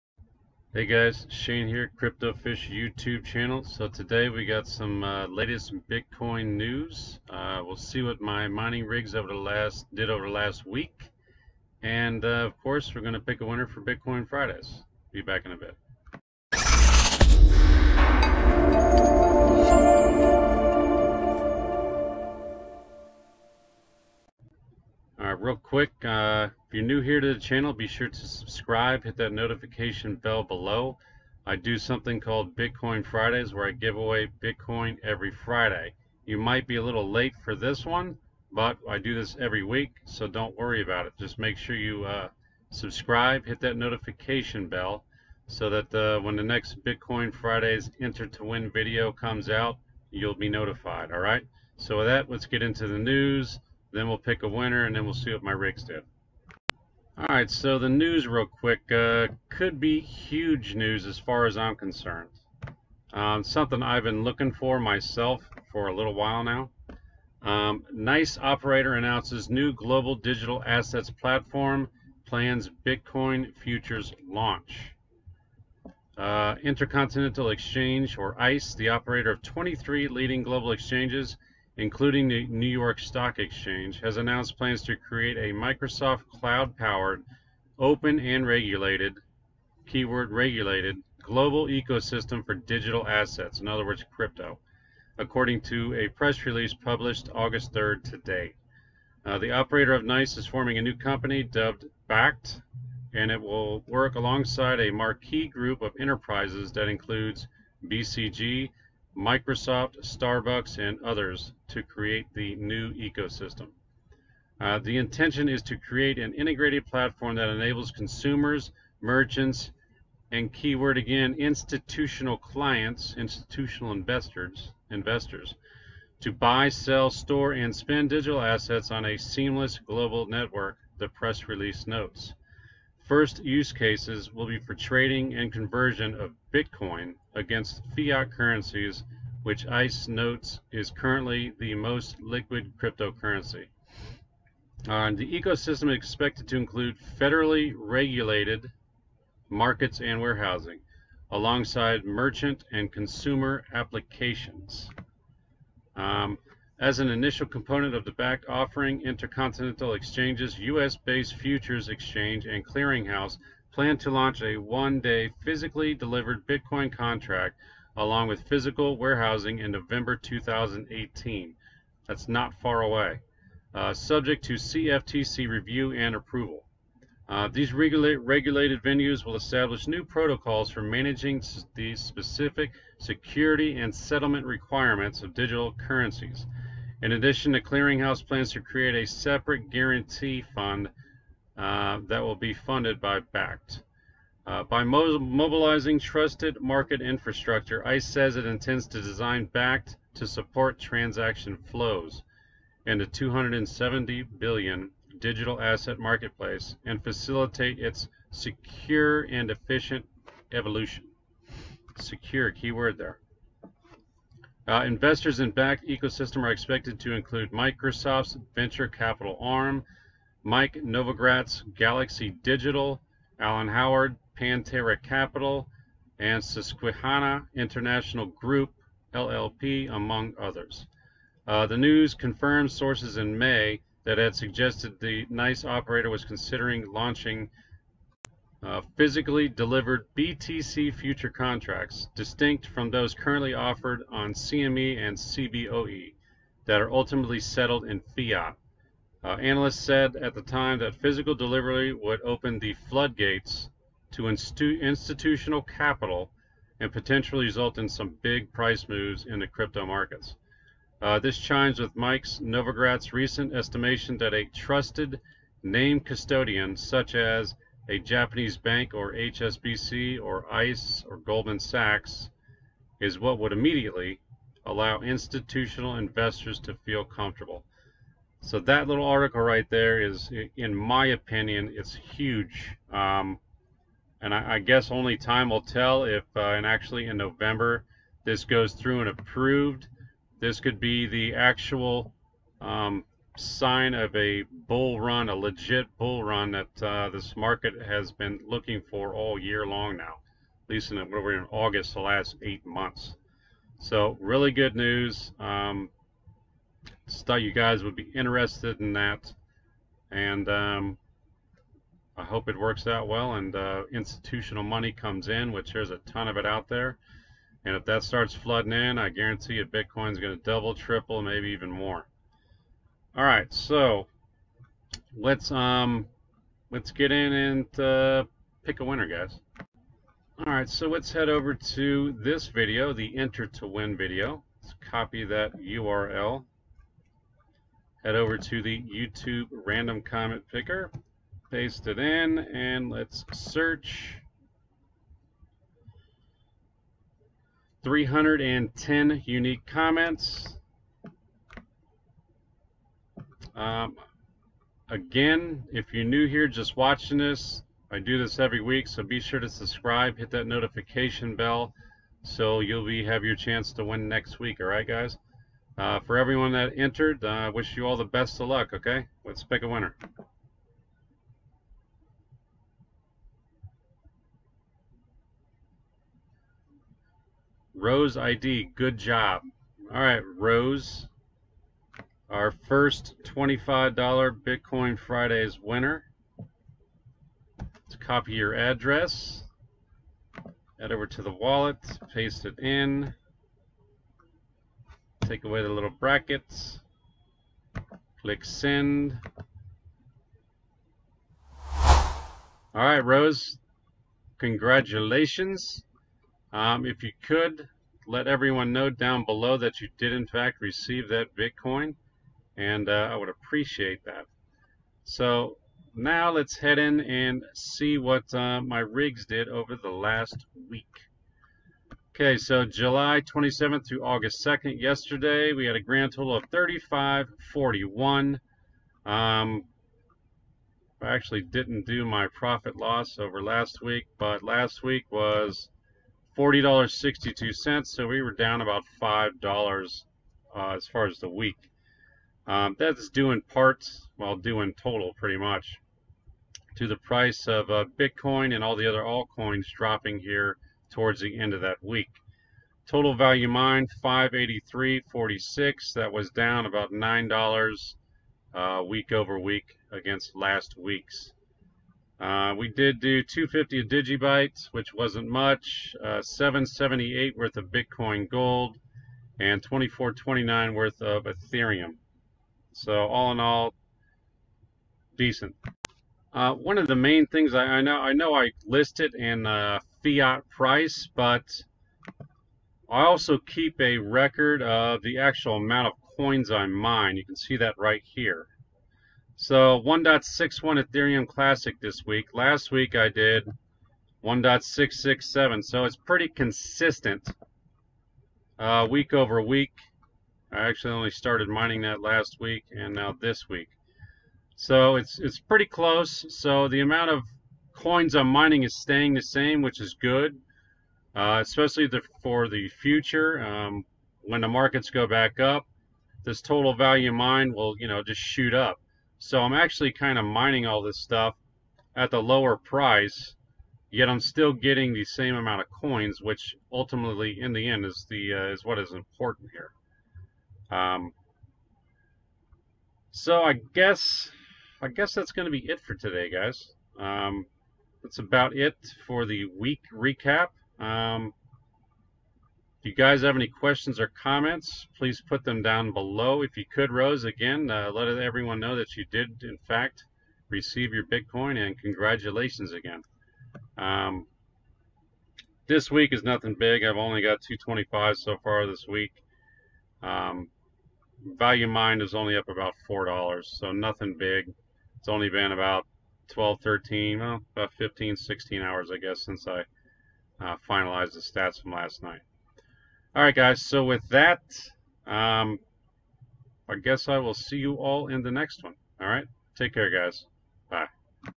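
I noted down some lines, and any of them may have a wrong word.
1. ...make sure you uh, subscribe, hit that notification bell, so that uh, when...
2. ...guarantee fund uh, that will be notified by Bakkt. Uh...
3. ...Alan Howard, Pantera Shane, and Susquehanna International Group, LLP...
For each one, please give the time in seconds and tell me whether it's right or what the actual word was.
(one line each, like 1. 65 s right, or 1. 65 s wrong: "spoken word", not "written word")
1. 41 s right
2. 189 s wrong: "funded", not "notified"
3. 223 s wrong: "Capital", not "Shane".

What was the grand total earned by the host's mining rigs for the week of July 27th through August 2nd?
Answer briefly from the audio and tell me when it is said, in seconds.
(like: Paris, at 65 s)
35.41, at 426 s.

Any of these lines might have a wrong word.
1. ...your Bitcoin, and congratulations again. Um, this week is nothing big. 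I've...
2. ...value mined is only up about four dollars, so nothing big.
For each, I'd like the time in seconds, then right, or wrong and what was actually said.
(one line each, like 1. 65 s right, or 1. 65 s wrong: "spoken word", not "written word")
1. 550 s right
2. 561 s right.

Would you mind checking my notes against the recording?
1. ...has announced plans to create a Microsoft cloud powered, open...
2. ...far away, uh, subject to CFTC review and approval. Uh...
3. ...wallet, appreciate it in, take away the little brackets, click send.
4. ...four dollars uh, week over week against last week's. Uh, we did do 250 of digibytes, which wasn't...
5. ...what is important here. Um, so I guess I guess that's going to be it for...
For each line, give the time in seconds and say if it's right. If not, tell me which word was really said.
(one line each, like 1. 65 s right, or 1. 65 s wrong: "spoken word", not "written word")
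1. 84 s right
2. 172 s right
3. 391 s wrong: "paste", not "appreciate"
4. 456 s wrong: "nine", not "four"
5. 528 s right.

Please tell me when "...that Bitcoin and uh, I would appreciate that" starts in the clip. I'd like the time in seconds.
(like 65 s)
411 s.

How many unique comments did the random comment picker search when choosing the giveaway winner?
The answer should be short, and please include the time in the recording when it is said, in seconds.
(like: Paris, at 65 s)
310, at 347 s.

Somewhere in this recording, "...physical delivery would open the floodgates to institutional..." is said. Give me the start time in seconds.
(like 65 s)
250 s.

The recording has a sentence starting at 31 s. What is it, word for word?
I do something called Bitcoin Fridays where I give away Bitcoin every Friday.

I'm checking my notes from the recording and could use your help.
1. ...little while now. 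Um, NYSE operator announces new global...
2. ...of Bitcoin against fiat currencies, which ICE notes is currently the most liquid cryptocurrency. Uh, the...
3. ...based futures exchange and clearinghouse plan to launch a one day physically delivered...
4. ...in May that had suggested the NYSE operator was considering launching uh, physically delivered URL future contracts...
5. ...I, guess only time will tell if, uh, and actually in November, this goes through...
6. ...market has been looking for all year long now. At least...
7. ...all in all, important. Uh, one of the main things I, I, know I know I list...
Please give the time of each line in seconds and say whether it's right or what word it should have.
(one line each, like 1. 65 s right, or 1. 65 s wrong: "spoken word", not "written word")
1. 65 s right
2. 136 s right
3. 160 s right
4. 233 s wrong: "BTC", not "URL"
5. 284 s right
6. 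297 s right
7. 473 s wrong: "decent", not "important".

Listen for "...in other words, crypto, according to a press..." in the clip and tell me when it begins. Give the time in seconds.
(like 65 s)
93 s.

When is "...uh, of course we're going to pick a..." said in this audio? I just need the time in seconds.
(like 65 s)
12 s.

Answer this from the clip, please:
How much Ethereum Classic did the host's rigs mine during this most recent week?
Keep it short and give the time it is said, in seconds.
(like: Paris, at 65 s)
1.61, at 489 s.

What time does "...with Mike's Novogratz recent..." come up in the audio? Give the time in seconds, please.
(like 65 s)
261 s.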